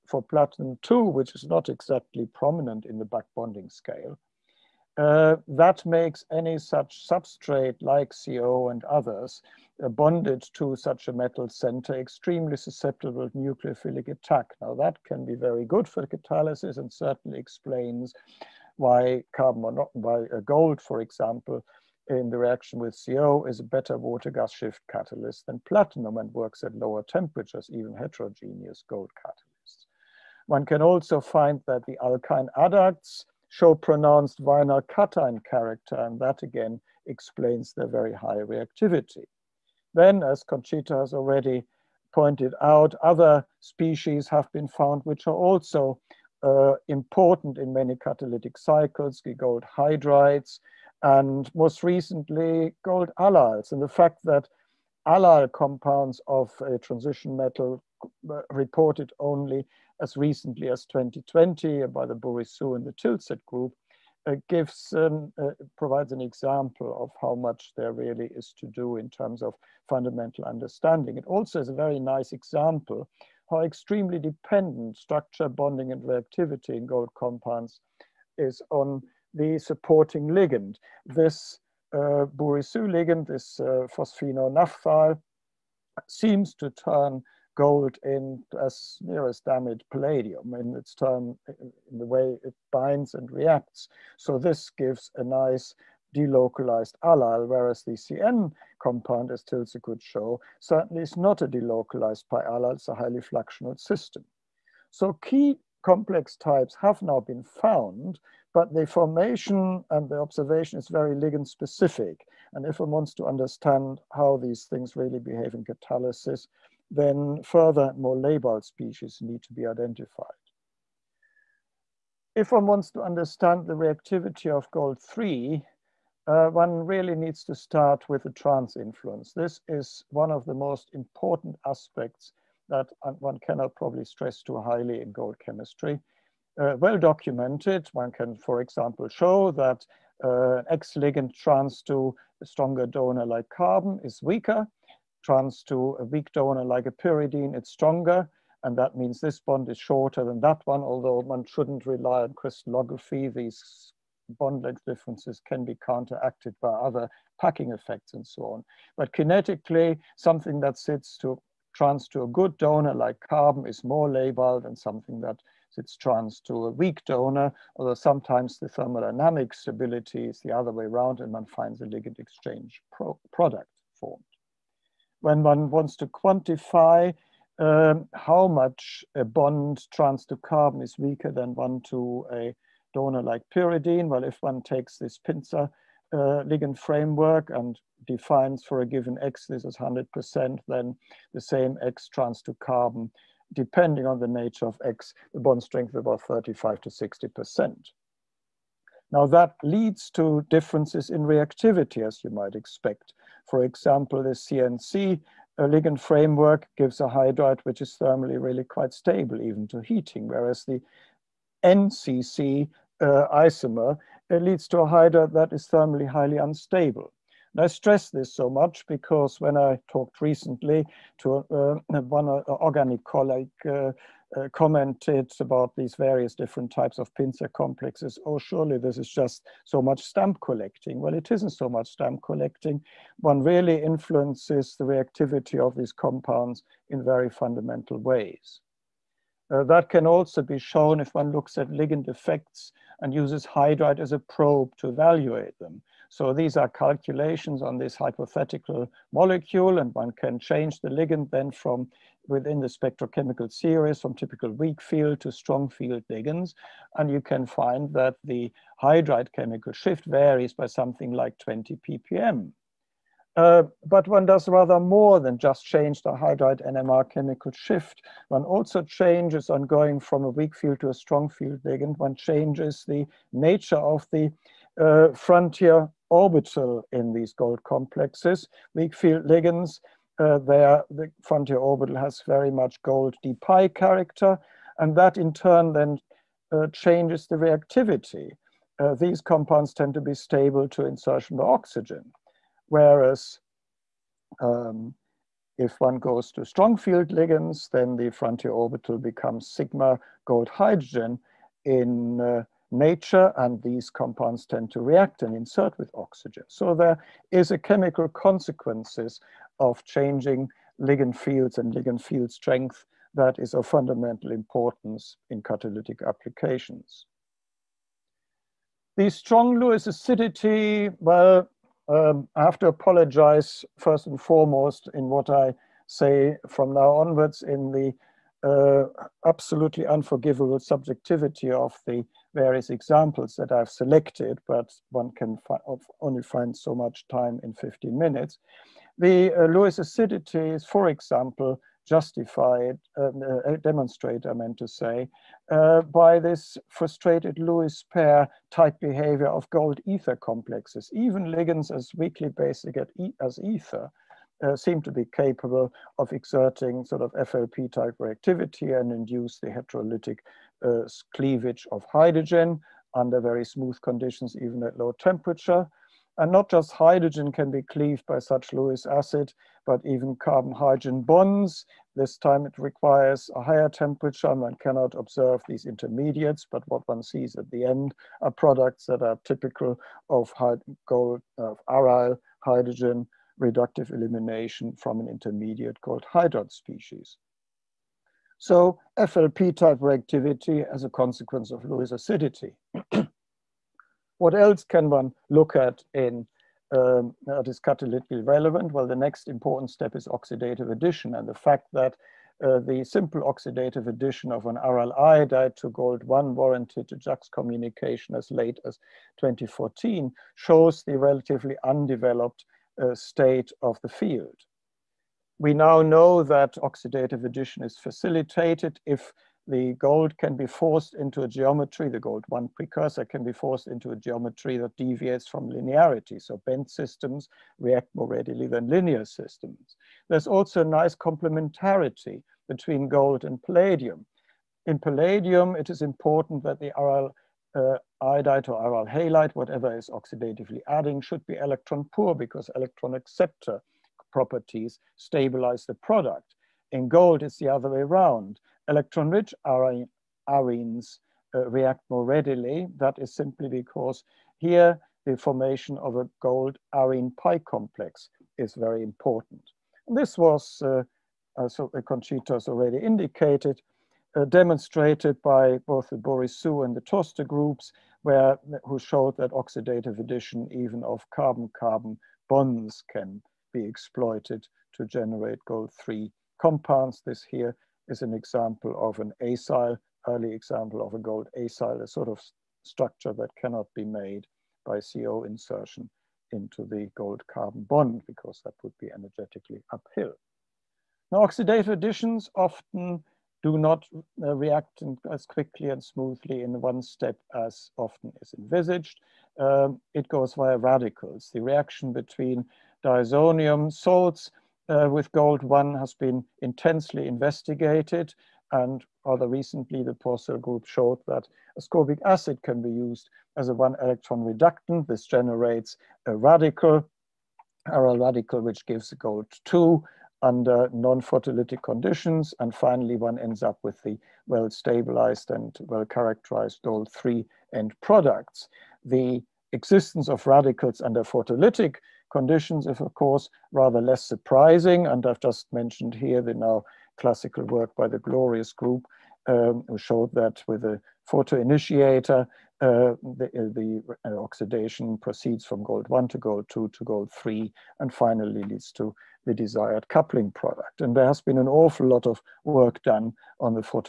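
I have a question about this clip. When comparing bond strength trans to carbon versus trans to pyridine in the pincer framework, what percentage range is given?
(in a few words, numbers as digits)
35 to 60%.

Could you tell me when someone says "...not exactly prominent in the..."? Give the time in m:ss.
0:01.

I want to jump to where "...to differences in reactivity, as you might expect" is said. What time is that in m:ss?
3:20.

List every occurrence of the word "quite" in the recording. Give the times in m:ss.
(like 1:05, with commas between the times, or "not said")
3:28.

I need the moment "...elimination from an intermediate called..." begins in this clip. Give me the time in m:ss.
6:23.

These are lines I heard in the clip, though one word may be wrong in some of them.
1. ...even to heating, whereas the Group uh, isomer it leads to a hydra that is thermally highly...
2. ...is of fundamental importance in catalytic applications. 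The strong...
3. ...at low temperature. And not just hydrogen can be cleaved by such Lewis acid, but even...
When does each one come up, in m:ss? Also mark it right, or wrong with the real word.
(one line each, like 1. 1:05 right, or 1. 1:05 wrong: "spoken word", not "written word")
1. 3:29 wrong: "NCC", not "Group"
2. 5:13 right
3. 6:04 right.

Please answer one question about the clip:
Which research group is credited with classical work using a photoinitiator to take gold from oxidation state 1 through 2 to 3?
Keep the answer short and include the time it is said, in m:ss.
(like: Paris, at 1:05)
Glorius Group, at 8:57.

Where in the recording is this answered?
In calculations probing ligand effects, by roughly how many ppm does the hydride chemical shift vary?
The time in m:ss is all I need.
4:21.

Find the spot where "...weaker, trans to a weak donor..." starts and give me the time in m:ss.
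2:24.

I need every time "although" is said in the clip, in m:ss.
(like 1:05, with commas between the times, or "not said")
2:30, 2:47.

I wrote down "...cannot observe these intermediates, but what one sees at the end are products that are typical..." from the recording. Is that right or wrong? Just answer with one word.
right.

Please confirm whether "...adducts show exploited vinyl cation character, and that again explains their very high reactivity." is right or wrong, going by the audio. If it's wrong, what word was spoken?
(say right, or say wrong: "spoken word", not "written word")
wrong: "pronounced", not "exploited".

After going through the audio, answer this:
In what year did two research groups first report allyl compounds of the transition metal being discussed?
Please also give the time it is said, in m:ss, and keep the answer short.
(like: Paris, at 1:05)
2020, at 1:00.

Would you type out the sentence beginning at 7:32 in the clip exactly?
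That is simply because here the formation of a gold arene pi complex is very important.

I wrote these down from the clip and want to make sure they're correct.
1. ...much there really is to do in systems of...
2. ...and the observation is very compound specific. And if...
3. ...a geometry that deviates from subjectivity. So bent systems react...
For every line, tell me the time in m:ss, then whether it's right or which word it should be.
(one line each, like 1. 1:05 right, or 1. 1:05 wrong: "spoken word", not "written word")
1. 1:07 wrong: "terms", not "systems"
2. 1:49 wrong: "ligand", not "compound"
3. 7:03 wrong: "linearity", not "subjectivity".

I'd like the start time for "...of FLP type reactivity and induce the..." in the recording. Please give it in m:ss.
5:57.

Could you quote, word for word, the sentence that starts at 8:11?
Now oxidative additions often do not uh, react in, as quickly and smoothly in one step as often is envisaged.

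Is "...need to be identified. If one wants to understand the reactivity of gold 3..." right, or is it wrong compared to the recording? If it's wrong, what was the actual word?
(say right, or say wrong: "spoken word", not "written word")
right.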